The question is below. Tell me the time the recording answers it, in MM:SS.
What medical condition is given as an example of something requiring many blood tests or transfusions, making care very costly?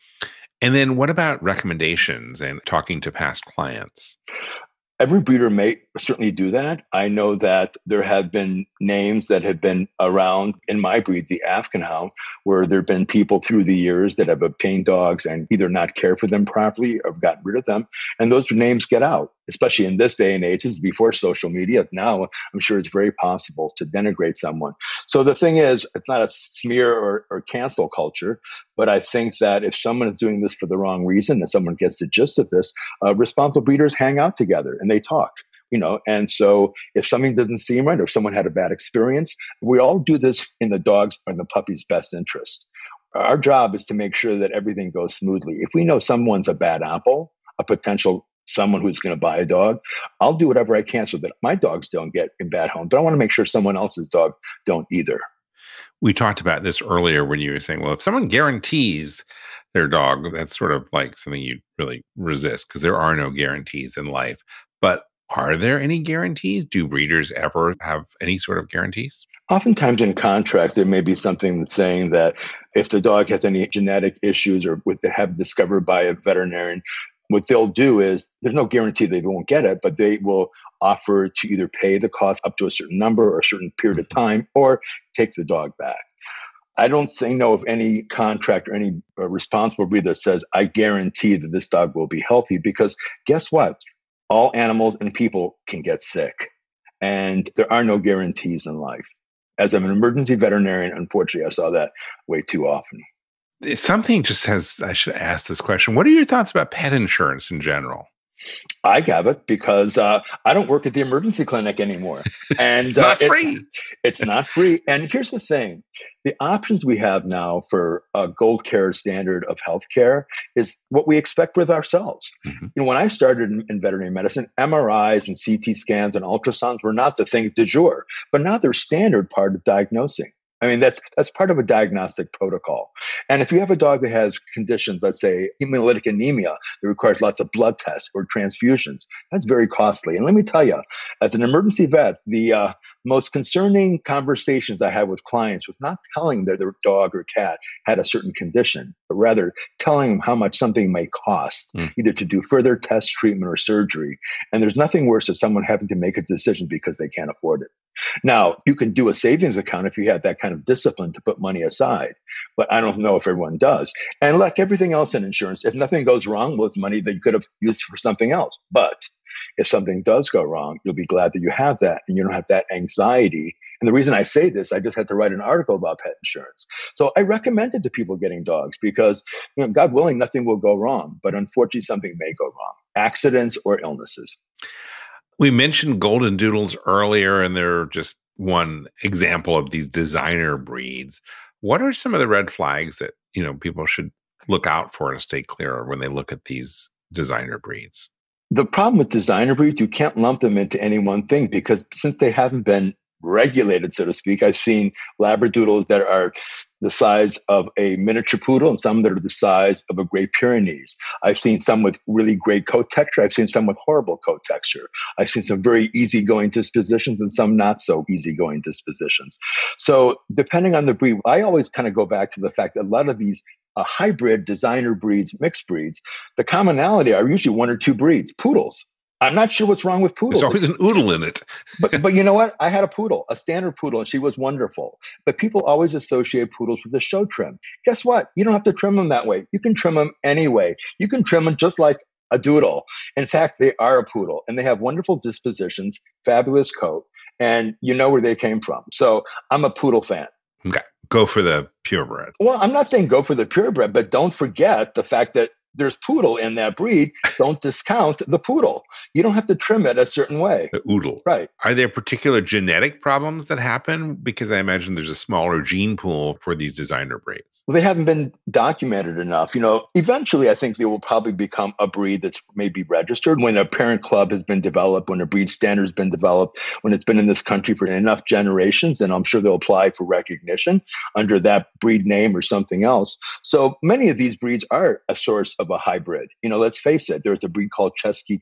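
02:15.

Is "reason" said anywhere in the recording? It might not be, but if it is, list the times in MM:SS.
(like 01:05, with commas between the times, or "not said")
00:31, 02:53.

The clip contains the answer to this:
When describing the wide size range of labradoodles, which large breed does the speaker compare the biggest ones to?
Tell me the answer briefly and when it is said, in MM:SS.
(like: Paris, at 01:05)
Great Pyrenees, at 03:30.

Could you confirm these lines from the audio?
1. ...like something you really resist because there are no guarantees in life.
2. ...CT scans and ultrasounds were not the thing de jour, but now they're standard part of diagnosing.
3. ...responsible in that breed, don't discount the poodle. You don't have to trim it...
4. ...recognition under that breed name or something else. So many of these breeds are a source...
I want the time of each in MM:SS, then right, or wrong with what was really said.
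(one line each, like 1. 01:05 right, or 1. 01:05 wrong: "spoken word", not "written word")
1. 01:00 right
2. 02:05 right
3. 04:15 wrong: "poodle", not "responsible"
4. 04:40 right.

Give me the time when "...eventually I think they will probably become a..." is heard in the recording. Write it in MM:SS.
04:29.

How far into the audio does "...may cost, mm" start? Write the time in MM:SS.
02:30.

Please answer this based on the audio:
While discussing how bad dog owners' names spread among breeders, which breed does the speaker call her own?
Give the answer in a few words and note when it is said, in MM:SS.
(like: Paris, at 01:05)
Afghan Hound, at 00:11.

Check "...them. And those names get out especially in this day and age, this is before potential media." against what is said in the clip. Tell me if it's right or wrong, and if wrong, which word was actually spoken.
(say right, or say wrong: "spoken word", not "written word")
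wrong: "social", not "potential".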